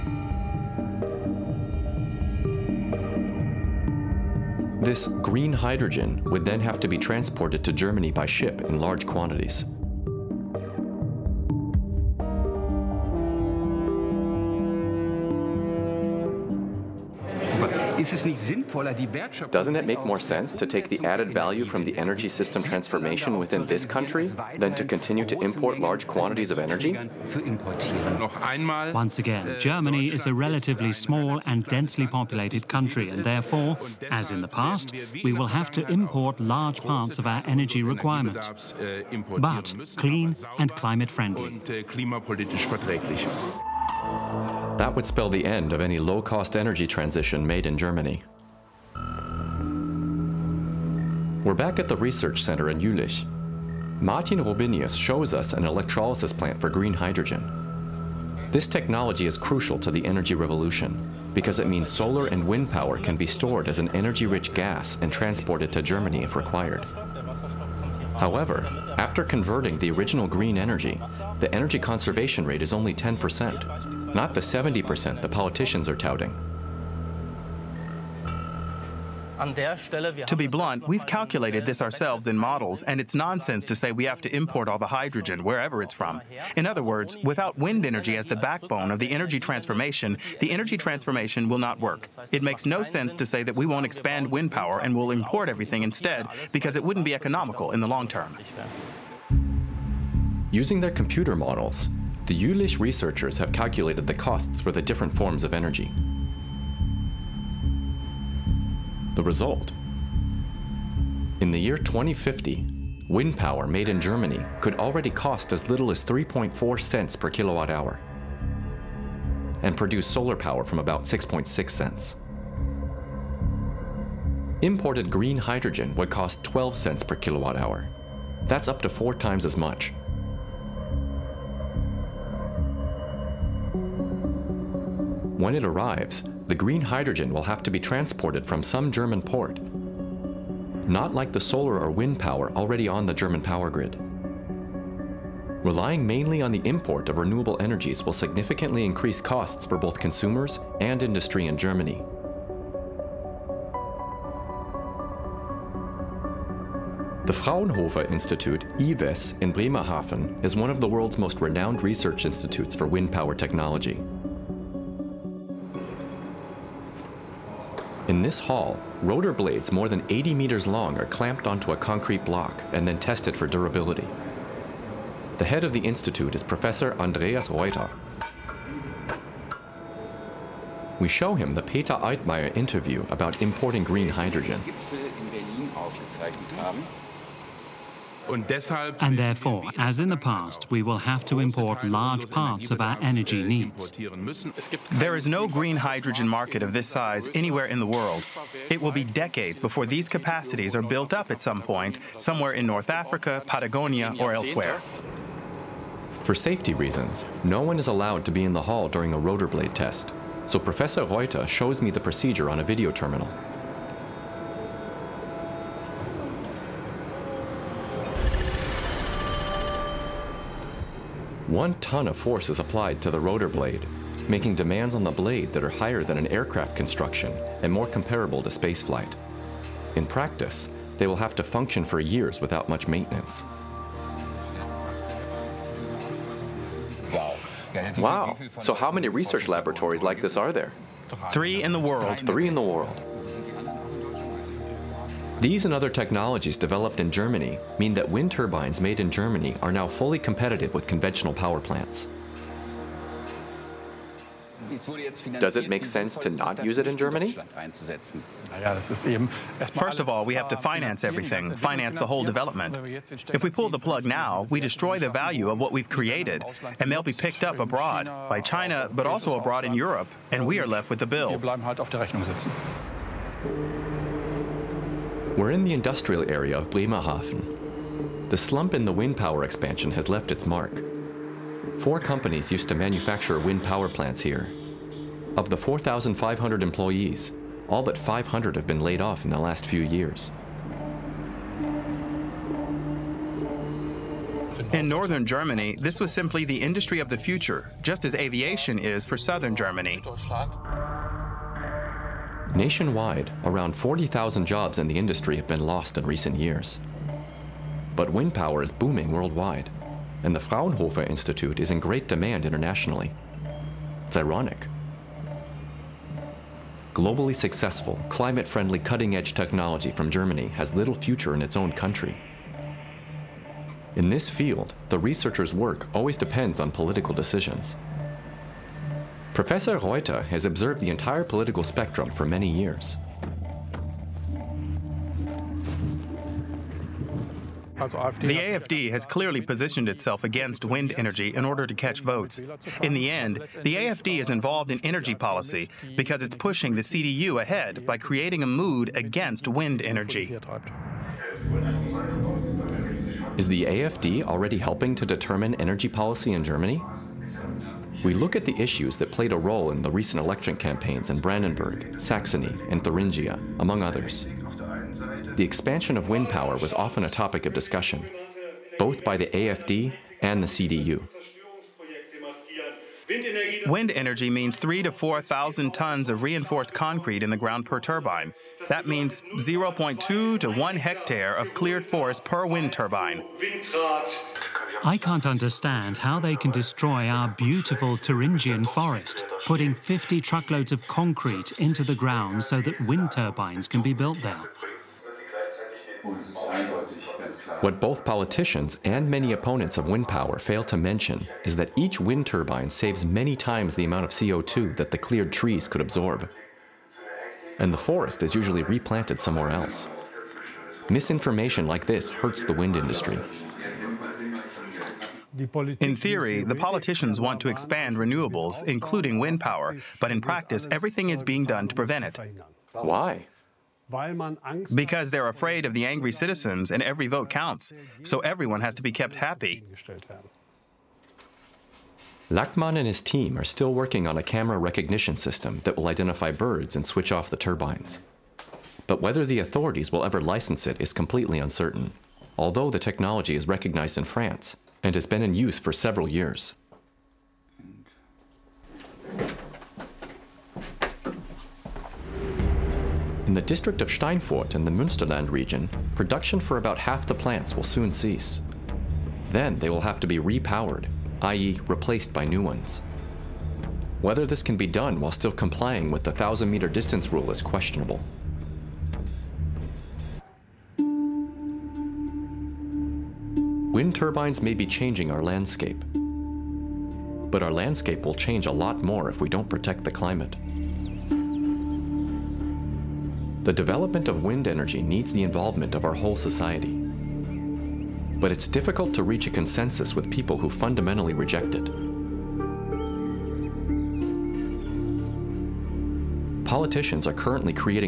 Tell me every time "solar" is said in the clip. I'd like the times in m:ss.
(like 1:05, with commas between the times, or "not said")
1:01, 2:00, 2:21.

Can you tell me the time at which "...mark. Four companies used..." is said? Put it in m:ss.
4:40.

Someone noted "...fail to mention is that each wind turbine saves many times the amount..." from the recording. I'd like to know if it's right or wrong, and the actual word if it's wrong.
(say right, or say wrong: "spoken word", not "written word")
right.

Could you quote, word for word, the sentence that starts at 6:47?
And the forest is usually replanted somewhere else.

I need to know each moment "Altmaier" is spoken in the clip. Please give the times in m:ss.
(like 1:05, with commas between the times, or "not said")
3:01.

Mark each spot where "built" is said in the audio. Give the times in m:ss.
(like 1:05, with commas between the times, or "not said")
3:20, 6:33.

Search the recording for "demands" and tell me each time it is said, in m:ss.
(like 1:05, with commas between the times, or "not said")
3:44, 5:12.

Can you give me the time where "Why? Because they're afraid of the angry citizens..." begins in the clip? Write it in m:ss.
7:02.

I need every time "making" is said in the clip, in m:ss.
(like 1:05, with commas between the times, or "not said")
3:44.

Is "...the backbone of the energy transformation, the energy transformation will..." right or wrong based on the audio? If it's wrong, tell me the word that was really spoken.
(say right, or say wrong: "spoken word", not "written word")
right.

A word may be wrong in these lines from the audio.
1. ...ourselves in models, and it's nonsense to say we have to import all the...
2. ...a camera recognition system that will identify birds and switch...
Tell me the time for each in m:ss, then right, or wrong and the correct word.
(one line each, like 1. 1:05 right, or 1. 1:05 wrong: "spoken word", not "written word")
1. 1:21 right
2. 7:14 right.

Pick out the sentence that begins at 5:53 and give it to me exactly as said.
Is the AFD already helping to determine energy policy in Germany?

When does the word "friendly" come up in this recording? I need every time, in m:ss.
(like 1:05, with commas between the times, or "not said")
0:41, 5:18.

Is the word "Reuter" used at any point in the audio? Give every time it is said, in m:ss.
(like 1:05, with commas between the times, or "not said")
2:57, 3:31, 5:29.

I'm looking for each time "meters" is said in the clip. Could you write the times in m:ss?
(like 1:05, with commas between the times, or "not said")
2:50, 7:46.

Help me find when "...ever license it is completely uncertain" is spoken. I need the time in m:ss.
7:20.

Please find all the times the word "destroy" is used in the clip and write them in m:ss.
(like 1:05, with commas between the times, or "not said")
4:24, 6:26.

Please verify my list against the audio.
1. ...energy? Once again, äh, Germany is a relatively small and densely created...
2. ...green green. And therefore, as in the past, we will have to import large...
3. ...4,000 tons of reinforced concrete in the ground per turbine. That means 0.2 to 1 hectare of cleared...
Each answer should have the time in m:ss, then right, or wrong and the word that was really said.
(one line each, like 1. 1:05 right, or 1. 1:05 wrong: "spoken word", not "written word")
1. 0:26 wrong: "populated", not "created"
2. 3:03 wrong: "hydrogen", not "green"
3. 6:14 right.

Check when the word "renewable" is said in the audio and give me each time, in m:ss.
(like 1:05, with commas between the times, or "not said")
2:27, 6:57.